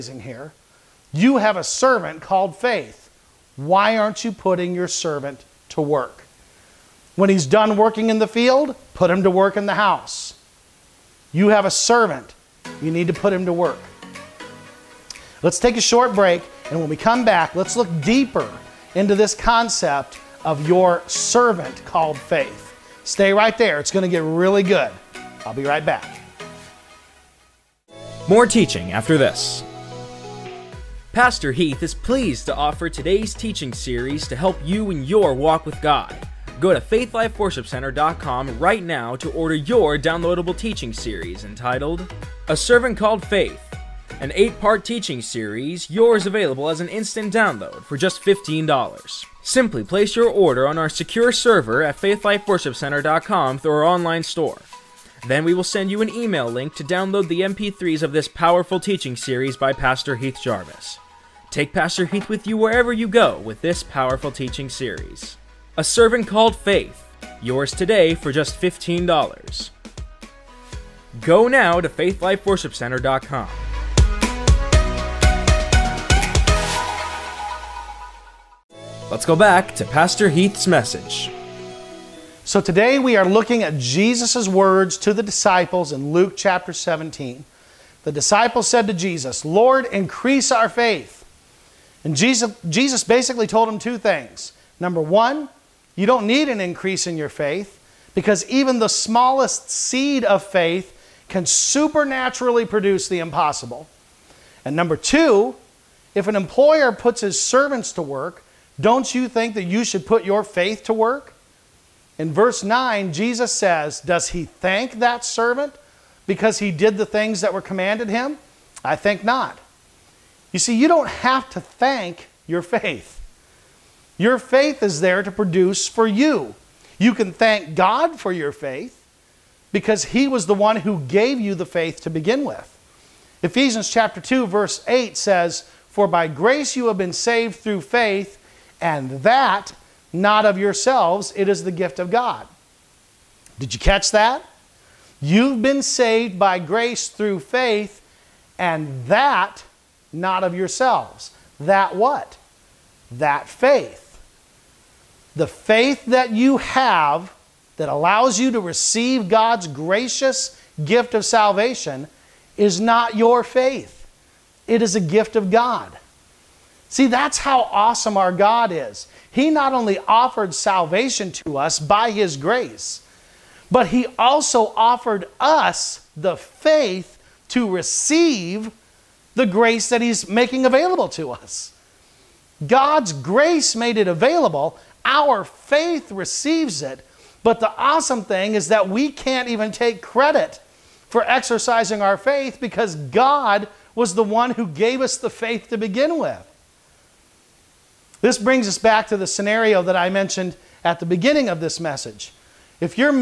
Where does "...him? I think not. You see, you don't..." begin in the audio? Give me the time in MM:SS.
01:58.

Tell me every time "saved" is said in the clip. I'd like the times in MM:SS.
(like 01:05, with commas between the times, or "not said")
02:17, 02:25.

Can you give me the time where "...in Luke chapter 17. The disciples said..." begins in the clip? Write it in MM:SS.
01:25.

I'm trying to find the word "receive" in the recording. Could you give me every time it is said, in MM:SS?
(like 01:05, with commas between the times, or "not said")
02:38, 02:57, 03:06.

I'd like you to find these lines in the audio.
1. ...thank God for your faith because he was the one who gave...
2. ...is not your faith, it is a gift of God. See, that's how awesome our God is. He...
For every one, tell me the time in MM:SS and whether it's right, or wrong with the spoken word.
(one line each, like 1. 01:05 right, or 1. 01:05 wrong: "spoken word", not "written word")
1. 02:07 right
2. 02:42 right.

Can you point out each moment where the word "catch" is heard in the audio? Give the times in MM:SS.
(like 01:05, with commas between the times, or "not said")
02:23.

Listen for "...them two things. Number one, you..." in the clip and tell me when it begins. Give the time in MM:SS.
01:33.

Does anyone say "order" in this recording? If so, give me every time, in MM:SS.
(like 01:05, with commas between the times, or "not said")
00:39, 00:50.